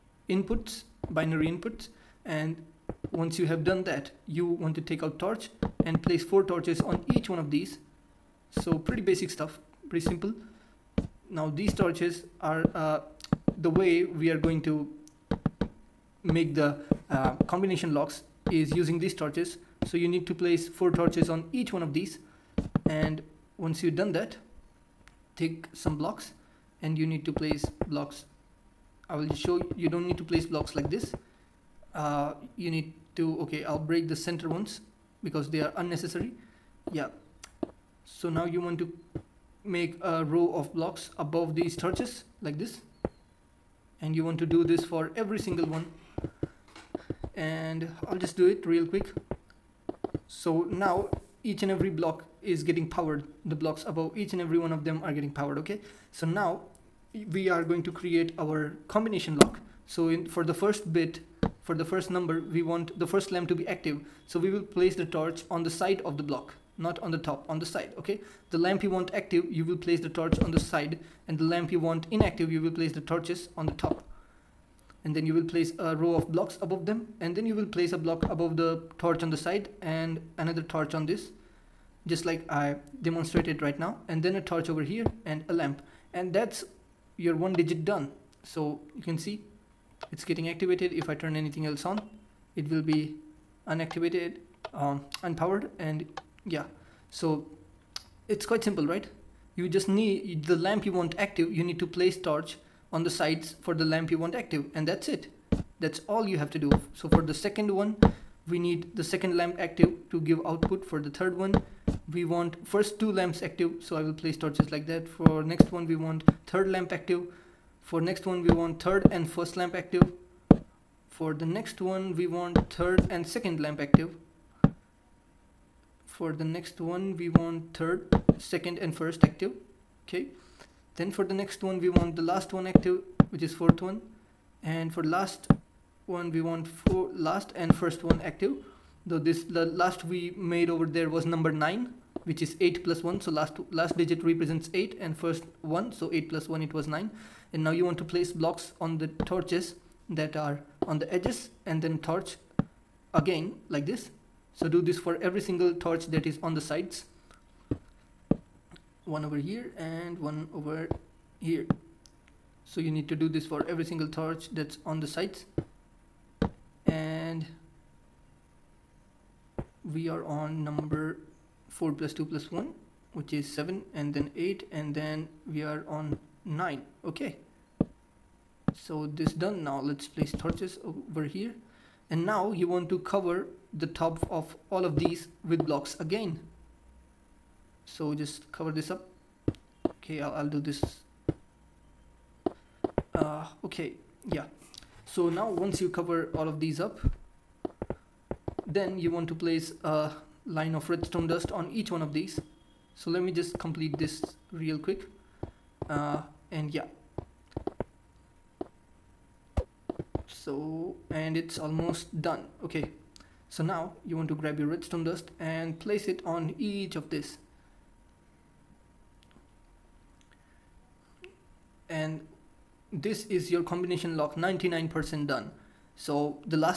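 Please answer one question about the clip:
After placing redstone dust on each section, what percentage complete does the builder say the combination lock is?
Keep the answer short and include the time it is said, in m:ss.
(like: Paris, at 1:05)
99%, at 3:44.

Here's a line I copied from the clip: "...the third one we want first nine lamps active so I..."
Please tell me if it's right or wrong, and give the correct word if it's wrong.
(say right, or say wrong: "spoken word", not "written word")
wrong: "two", not "nine".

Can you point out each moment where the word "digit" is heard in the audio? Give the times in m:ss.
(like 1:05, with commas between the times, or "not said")
1:27, 2:23.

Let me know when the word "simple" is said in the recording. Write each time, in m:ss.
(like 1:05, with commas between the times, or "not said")
0:10, 1:38.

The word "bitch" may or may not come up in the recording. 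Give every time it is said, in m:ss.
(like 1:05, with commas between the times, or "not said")
not said.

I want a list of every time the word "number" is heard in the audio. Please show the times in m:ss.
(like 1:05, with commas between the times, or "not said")
1:02, 2:21, 2:50.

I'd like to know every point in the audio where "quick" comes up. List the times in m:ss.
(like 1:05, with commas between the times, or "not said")
0:48, 3:24.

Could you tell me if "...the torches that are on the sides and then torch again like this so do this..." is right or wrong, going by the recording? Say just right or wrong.
wrong.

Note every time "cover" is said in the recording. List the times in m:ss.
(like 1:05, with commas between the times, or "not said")
3:02, 3:08, 3:15.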